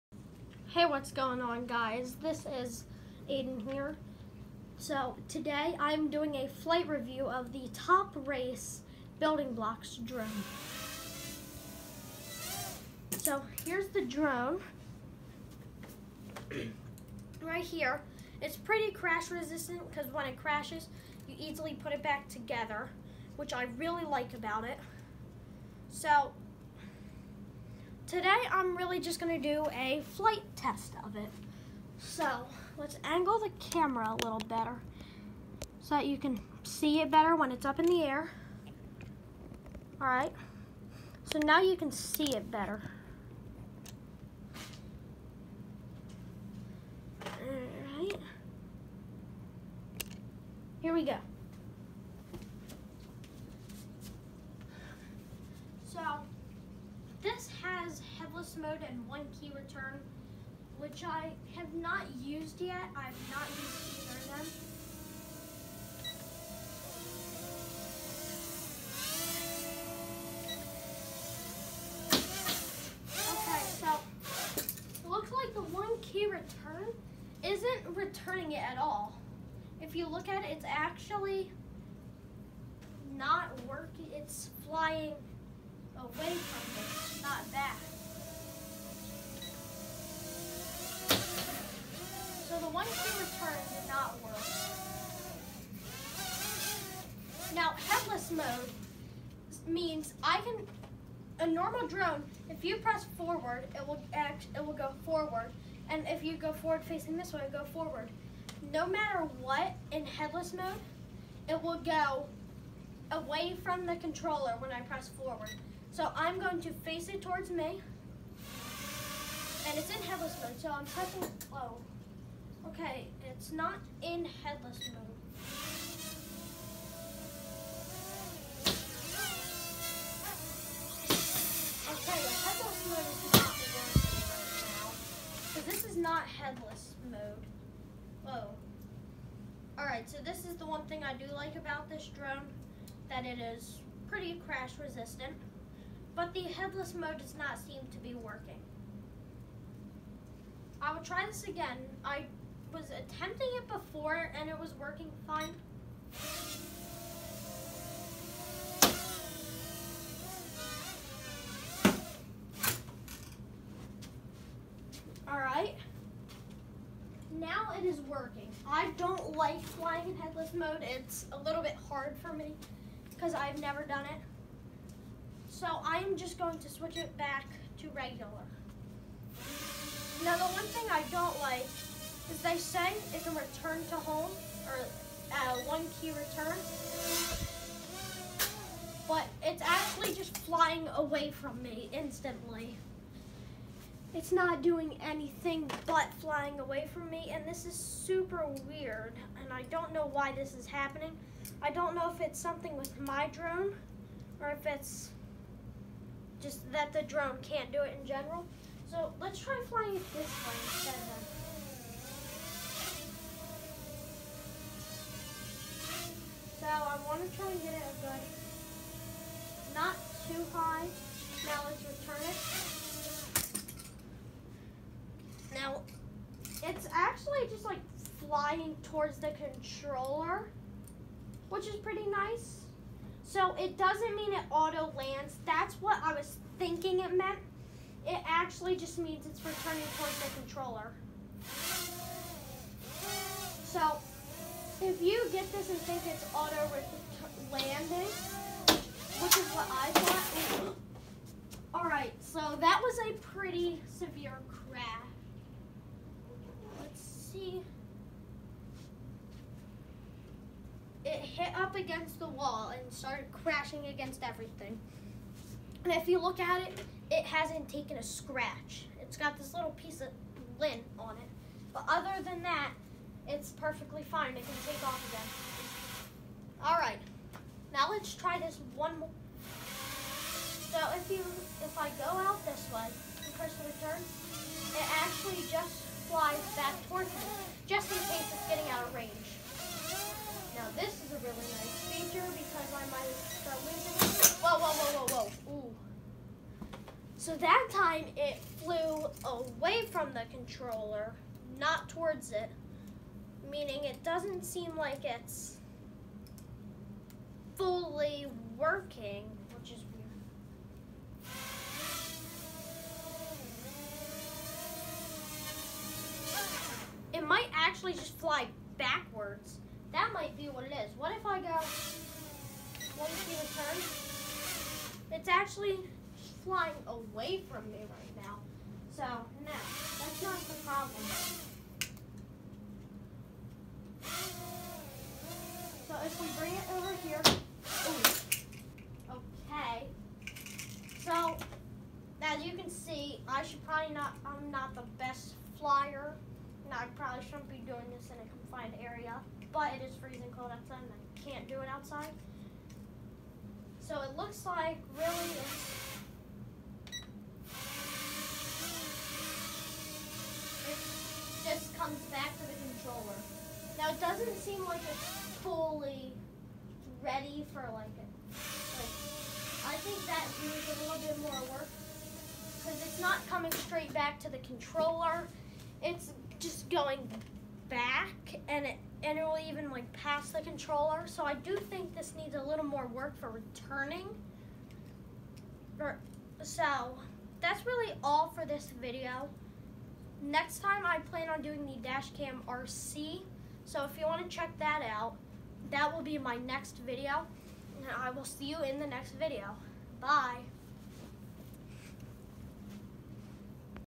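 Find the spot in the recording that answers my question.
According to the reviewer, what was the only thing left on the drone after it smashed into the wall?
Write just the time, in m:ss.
4:30.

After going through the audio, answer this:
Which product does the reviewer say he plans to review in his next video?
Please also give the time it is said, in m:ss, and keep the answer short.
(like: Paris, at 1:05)
Dashcam RC, at 6:31.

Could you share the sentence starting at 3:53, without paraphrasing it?
So it doesn't mean it auto lands.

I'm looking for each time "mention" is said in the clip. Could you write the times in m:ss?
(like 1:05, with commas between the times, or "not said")
not said.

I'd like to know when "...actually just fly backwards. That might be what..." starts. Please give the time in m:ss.
5:17.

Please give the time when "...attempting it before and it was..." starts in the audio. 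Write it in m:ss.
2:32.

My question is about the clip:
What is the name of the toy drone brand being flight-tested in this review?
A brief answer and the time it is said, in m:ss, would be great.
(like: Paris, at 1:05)
Top Race, at 0:07.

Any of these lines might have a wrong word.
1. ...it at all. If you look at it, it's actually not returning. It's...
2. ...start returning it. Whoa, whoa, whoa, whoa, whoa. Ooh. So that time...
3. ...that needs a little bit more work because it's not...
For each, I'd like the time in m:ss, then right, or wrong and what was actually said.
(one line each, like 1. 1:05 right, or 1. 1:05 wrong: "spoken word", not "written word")
1. 1:18 wrong: "working", not "returning"
2. 4:53 wrong: "losing", not "returning"
3. 6:10 right.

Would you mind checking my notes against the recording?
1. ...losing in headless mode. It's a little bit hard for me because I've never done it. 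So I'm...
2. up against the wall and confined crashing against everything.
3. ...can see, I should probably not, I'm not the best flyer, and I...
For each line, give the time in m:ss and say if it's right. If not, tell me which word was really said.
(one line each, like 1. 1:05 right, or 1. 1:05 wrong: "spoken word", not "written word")
1. 2:49 wrong: "flying", not "losing"
2. 4:21 wrong: "started", not "confined"
3. 5:42 right.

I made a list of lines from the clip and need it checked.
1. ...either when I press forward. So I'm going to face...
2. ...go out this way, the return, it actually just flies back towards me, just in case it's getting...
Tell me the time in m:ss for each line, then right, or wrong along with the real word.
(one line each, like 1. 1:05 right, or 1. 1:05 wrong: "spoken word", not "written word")
1. 1:53 wrong: "controller", not "either"
2. 4:41 right.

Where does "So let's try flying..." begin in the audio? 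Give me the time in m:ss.
3:28.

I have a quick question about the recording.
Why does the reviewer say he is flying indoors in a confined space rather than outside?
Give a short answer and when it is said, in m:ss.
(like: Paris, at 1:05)
freezing cold outside, at 5:49.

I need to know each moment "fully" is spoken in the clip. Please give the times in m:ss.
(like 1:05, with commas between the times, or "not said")
5:07, 6:05.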